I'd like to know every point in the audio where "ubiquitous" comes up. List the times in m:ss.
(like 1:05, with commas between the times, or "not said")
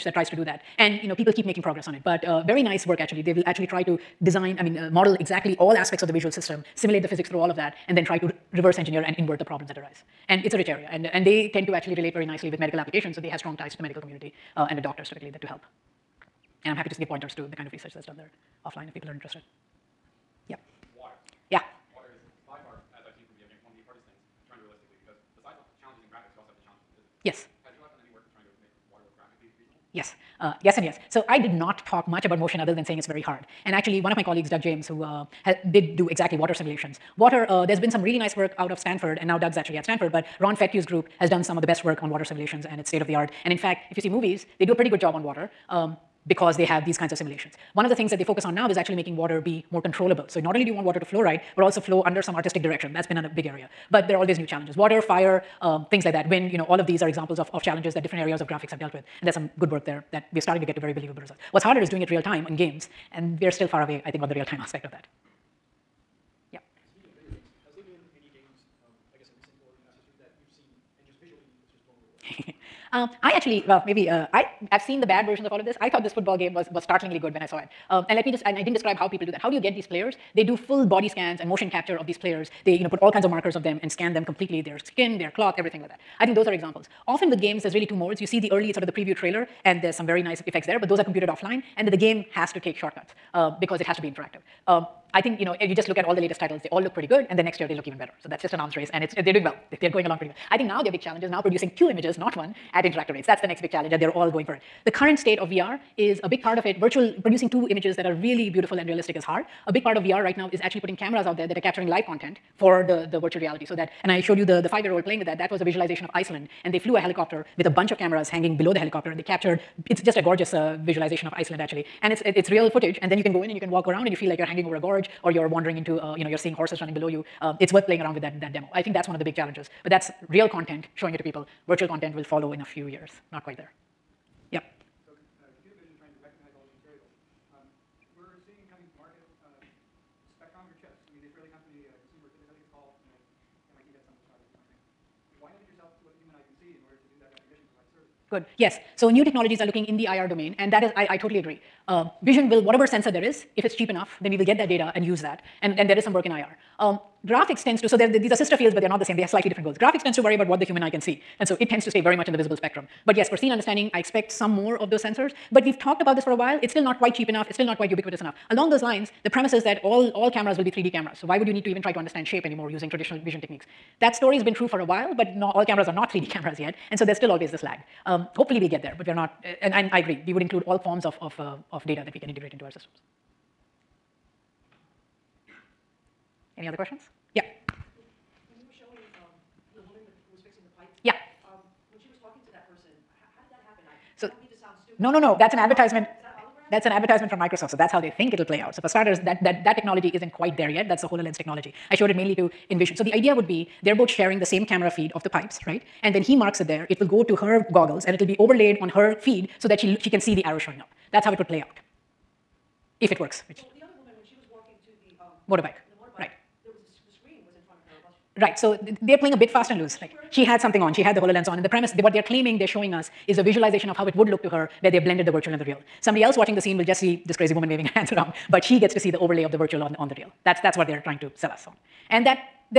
2:47.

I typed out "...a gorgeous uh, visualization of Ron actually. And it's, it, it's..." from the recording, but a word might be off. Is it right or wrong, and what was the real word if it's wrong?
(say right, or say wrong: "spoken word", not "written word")
wrong: "Iceland", not "Ron".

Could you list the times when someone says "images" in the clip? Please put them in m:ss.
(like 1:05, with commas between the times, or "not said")
1:41, 1:47.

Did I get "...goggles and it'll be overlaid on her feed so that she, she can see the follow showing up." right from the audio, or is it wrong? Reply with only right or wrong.
wrong.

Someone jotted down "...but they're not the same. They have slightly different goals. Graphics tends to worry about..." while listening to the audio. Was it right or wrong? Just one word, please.
right.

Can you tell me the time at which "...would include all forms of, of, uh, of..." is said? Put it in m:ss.
3:00.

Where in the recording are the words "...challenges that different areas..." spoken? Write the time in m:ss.
0:57.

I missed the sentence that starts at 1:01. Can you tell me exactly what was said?
What's harder is doing it real time in games I've seen the bad versions of all of this.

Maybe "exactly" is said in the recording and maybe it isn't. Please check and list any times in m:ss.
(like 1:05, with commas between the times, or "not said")
0:05, 0:36.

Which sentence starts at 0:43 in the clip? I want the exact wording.
And in fact, if you see movies, they do a pretty good job on water.